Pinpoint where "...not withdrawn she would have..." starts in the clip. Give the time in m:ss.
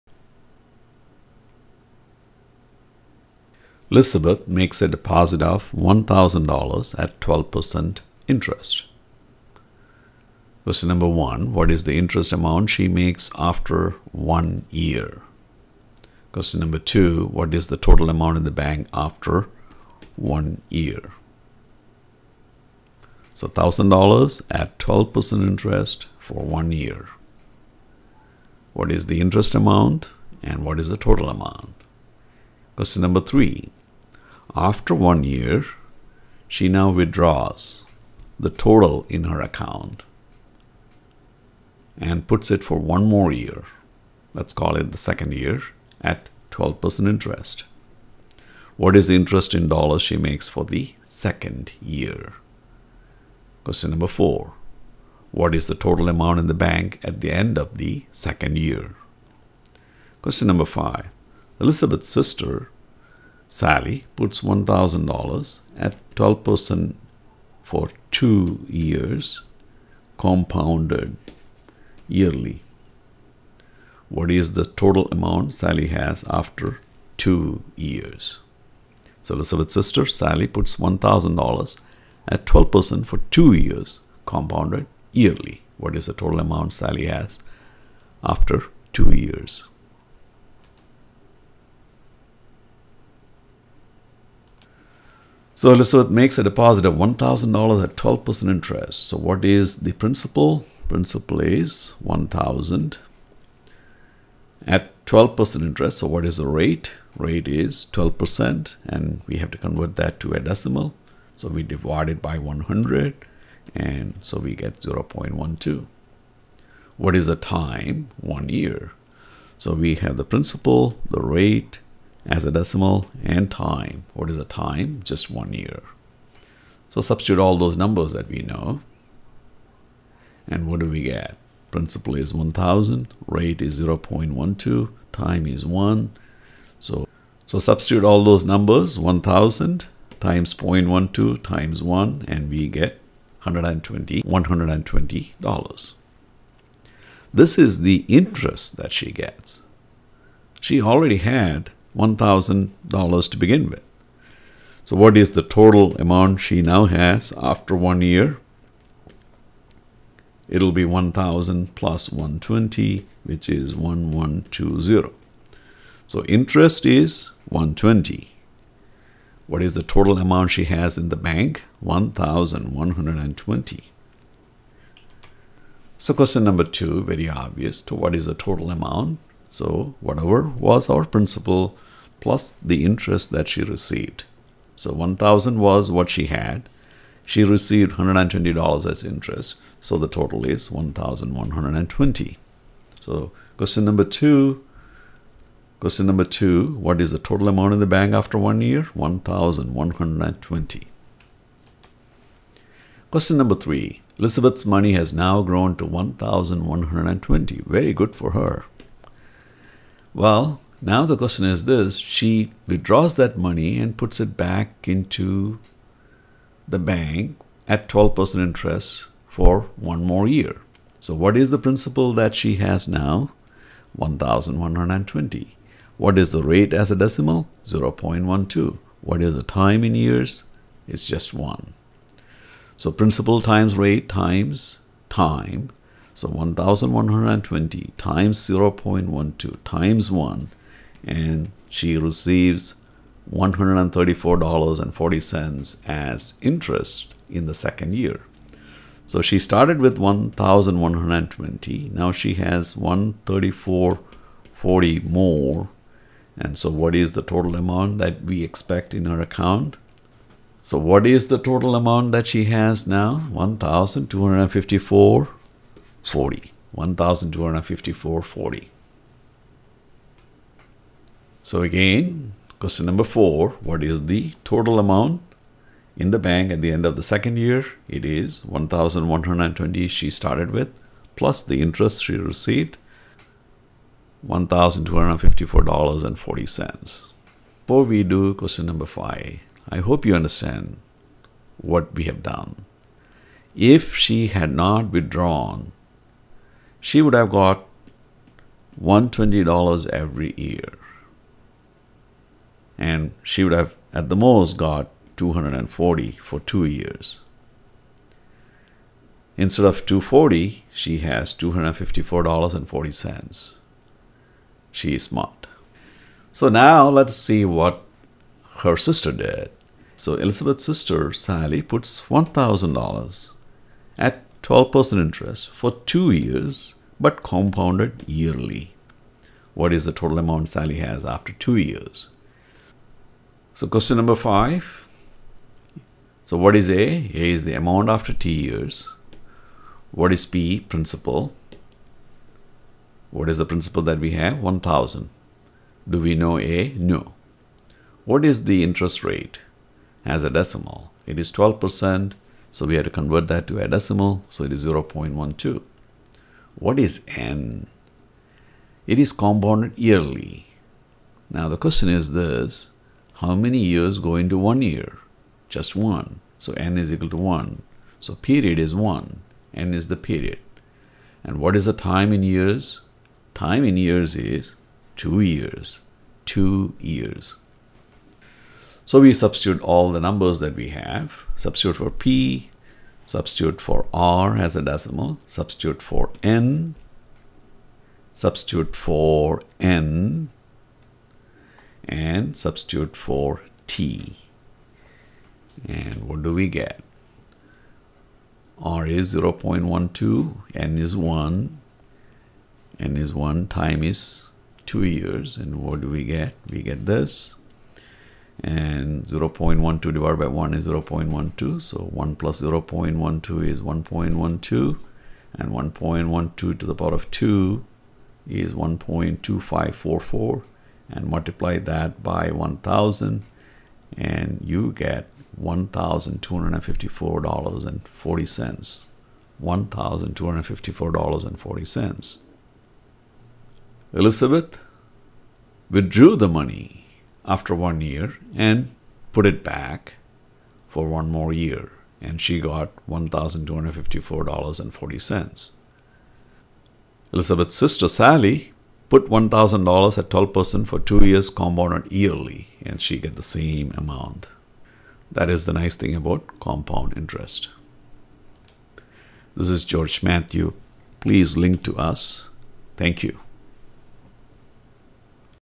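4:54.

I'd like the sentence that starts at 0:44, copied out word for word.
Let's call it the second year at 12% interest.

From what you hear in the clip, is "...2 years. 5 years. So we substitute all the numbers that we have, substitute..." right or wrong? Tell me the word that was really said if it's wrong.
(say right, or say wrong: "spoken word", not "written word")
wrong: "2", not "5".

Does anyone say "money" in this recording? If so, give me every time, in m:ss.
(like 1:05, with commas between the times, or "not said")
3:24, 3:33.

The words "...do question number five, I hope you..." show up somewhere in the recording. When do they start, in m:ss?
4:48.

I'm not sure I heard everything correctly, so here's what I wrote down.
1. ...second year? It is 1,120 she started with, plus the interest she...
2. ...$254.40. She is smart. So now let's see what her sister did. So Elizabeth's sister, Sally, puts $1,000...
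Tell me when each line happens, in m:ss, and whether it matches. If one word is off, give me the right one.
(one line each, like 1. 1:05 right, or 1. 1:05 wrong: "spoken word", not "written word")
1. 4:37 right
2. 5:11 right.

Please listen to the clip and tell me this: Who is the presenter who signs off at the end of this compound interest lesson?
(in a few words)
George Mathew.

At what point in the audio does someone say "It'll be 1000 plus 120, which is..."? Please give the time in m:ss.
2:40.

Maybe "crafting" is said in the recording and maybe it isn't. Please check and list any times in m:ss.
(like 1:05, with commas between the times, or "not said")
not said.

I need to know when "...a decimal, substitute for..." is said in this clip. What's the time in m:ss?
6:24.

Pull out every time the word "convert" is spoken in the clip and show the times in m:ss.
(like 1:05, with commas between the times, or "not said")
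1:49, 5:52.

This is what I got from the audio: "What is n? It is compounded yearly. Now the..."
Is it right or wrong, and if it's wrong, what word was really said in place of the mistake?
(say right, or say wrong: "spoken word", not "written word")
right.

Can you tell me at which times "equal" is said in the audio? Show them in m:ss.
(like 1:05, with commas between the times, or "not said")
6:06.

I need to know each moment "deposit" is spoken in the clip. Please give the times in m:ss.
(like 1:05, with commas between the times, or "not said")
0:04, 1:36.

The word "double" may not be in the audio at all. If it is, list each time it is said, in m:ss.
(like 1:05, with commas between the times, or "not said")
not said.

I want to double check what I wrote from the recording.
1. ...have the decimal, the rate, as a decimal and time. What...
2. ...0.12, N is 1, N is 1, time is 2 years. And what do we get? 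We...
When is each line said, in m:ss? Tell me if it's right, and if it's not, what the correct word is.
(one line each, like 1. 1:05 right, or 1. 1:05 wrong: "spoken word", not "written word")
1. 1:59 wrong: "principal", not "decimal"
2. 6:39 right.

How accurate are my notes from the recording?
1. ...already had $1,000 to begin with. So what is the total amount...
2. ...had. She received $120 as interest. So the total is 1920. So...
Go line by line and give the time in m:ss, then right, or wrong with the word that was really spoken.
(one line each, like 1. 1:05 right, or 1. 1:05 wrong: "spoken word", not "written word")
1. 2:30 right
2. 3:06 wrong: "1120", not "1920".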